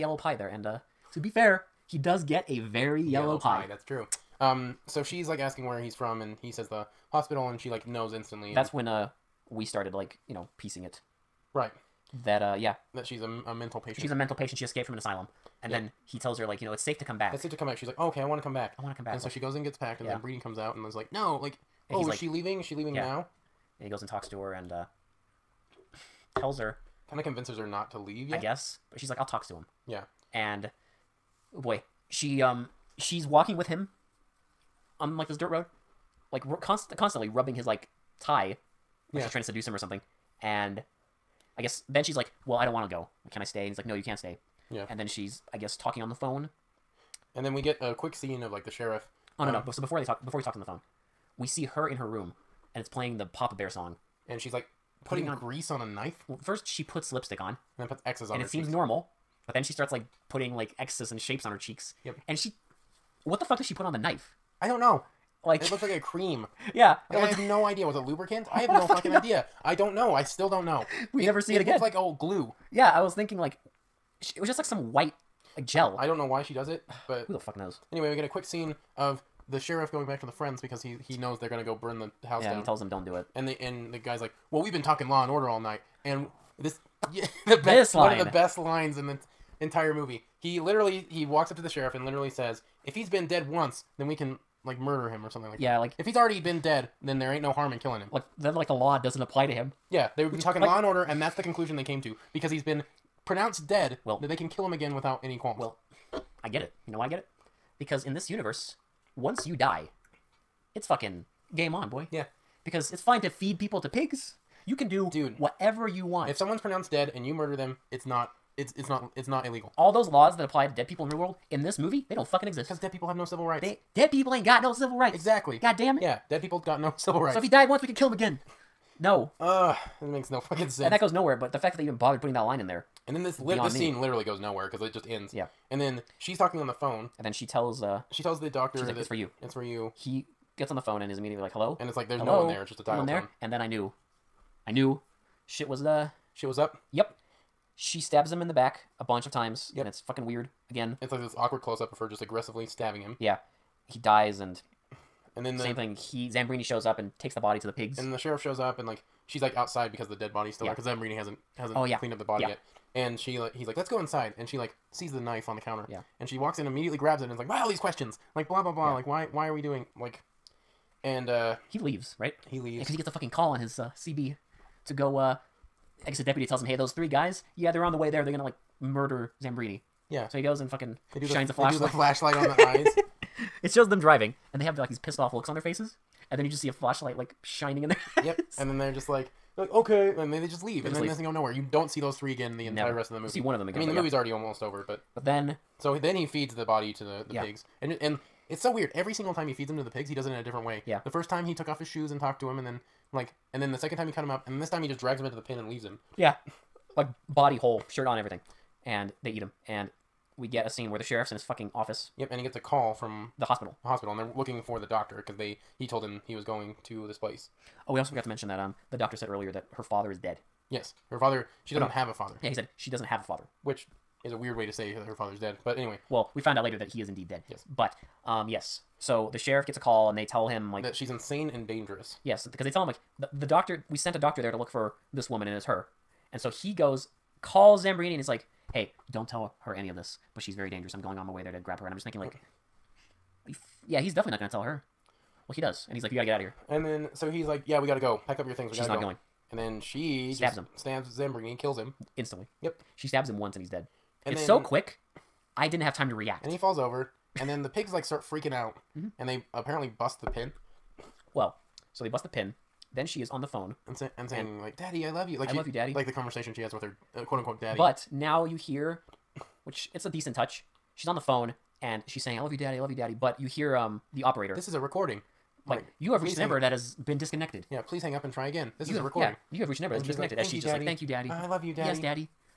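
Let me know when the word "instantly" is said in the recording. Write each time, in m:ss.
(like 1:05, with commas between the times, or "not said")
0:08, 4:12.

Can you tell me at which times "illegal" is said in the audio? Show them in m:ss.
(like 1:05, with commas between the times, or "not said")
1:59.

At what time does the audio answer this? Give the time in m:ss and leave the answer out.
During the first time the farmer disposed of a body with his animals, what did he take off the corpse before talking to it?
3:21.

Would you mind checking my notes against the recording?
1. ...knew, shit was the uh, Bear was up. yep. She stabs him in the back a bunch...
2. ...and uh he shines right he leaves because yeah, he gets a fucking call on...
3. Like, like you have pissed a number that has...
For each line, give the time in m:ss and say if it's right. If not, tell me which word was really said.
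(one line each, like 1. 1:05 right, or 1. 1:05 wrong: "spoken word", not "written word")
1. 2:24 wrong: "Shit", not "Bear"
2. 2:51 wrong: "leaves", not "shines"
3. 4:35 wrong: "reached", not "pissed".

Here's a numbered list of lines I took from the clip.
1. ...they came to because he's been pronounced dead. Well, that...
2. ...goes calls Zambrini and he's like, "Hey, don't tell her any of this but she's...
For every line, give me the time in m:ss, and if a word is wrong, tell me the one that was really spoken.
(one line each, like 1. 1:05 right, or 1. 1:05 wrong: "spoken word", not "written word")
1. 1:41 right
2. 3:56 right.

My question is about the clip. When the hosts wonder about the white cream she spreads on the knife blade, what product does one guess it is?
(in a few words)
Lubricant.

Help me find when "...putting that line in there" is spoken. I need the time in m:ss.
2:12.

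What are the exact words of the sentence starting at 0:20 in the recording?
then breeding comes out and is like no like and oh is like, she leaving is she leaving yeah.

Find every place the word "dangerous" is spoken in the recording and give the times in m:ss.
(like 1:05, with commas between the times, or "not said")
3:51, 4:00.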